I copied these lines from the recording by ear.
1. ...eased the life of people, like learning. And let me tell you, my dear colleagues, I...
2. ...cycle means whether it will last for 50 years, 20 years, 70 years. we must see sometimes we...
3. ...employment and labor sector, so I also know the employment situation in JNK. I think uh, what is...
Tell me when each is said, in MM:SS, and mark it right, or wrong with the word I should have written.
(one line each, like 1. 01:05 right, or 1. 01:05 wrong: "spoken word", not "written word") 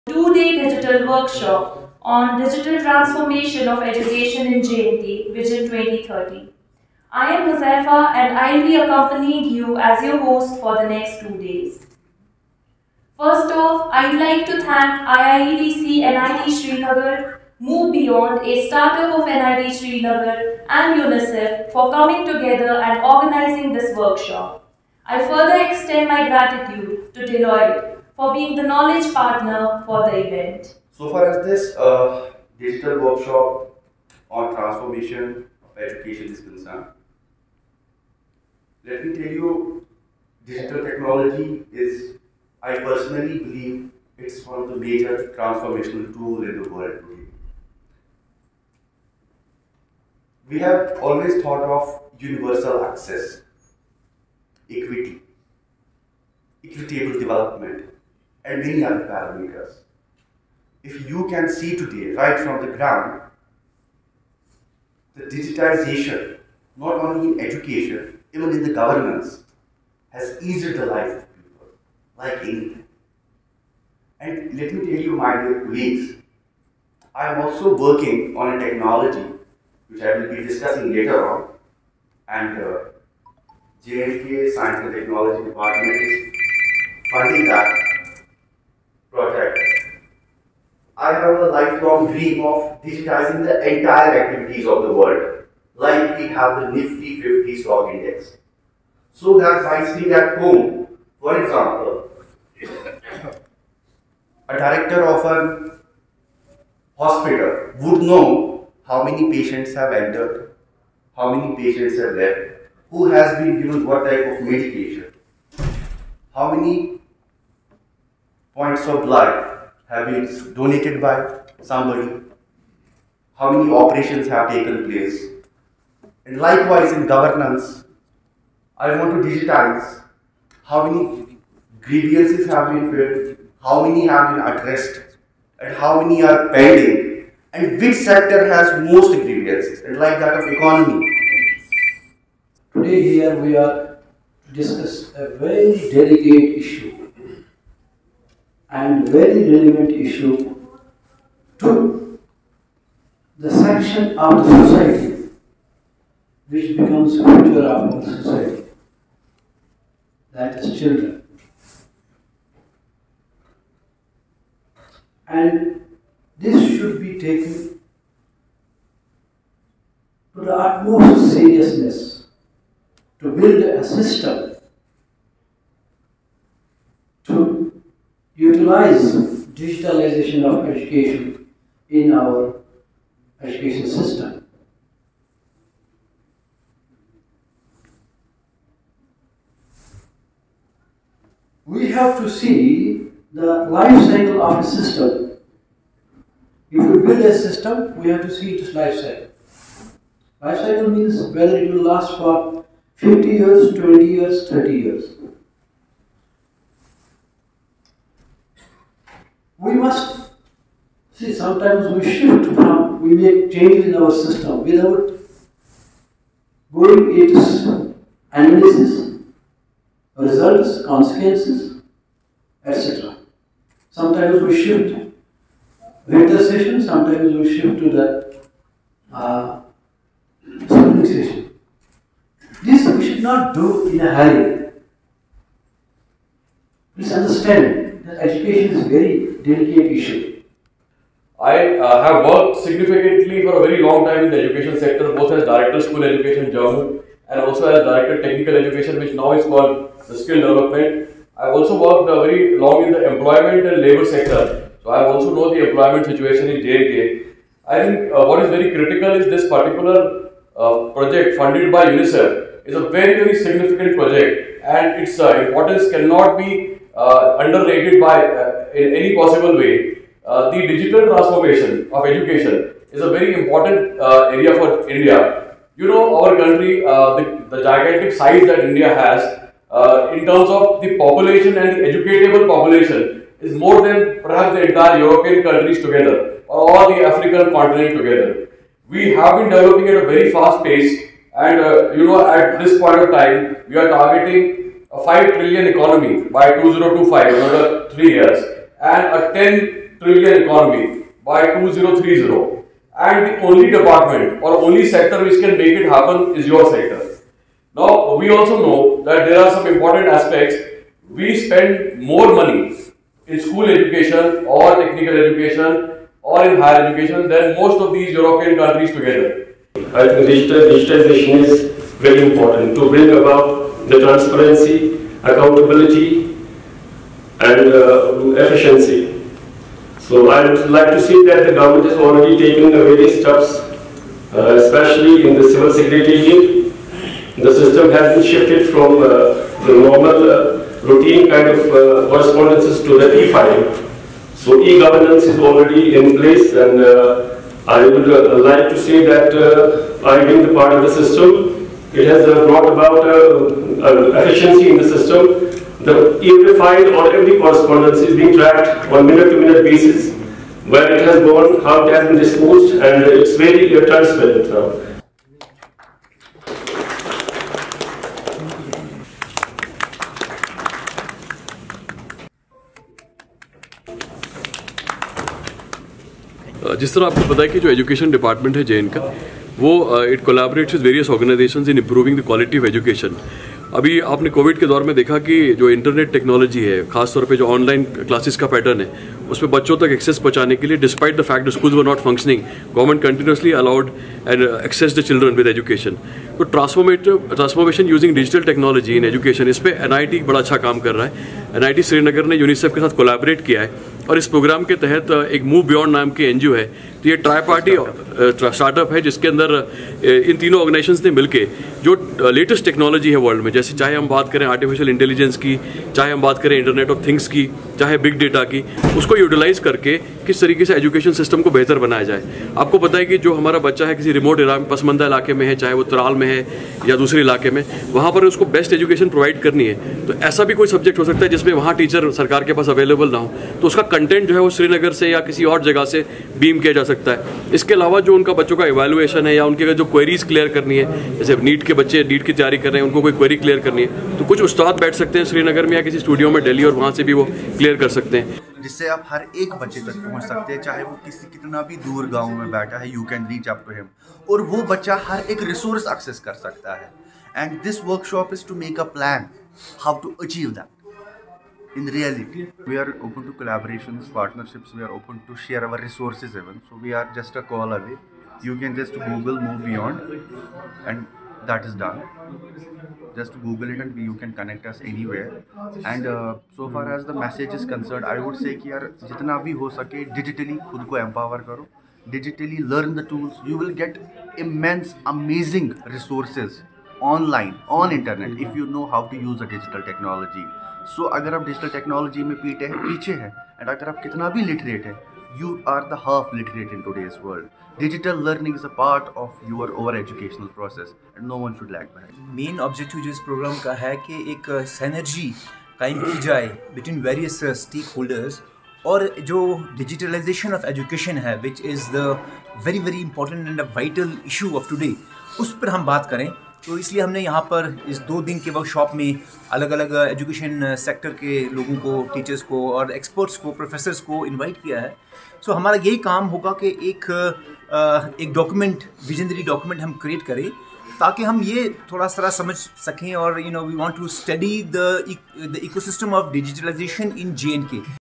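1. 01:10 wrong: "anything", not "learning"
2. 03:20 wrong: "30", not "70"
3. 04:13 right.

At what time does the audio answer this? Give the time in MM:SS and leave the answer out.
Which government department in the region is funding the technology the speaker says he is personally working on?
01:24.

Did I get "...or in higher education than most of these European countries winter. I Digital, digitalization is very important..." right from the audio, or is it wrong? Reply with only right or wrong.
wrong.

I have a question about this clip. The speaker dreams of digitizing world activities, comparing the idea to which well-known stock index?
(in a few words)
Nifty 50.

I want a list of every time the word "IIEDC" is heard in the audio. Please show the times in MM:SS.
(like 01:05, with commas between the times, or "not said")
00:15.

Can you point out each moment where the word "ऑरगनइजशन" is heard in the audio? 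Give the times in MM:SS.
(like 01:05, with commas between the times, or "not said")
06:21, 06:50.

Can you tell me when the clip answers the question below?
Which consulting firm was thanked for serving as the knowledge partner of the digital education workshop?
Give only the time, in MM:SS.
00:27.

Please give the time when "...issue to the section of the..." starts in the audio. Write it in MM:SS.
02:29.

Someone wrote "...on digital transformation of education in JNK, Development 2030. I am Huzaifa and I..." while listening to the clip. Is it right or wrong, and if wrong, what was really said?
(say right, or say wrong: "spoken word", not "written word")
wrong: "Vision", not "Development".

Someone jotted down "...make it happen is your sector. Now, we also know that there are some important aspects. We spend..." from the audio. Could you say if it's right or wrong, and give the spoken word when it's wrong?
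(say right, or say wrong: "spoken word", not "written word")
right.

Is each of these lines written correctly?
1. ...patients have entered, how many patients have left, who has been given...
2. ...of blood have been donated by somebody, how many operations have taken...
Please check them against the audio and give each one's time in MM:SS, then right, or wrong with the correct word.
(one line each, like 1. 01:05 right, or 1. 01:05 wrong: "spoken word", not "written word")
1. 01:49 right
2. 01:58 right.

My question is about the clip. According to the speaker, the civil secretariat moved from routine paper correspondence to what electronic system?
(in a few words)
e-filing.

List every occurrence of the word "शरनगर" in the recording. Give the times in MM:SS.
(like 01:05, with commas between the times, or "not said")
06:41, 07:14, 07:25.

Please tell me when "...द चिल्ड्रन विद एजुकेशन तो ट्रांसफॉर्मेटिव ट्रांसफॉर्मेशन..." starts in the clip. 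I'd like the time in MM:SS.
06:34.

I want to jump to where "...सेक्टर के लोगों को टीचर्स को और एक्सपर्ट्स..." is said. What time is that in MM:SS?
08:40.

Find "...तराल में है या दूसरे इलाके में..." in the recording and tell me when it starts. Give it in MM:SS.
07:05.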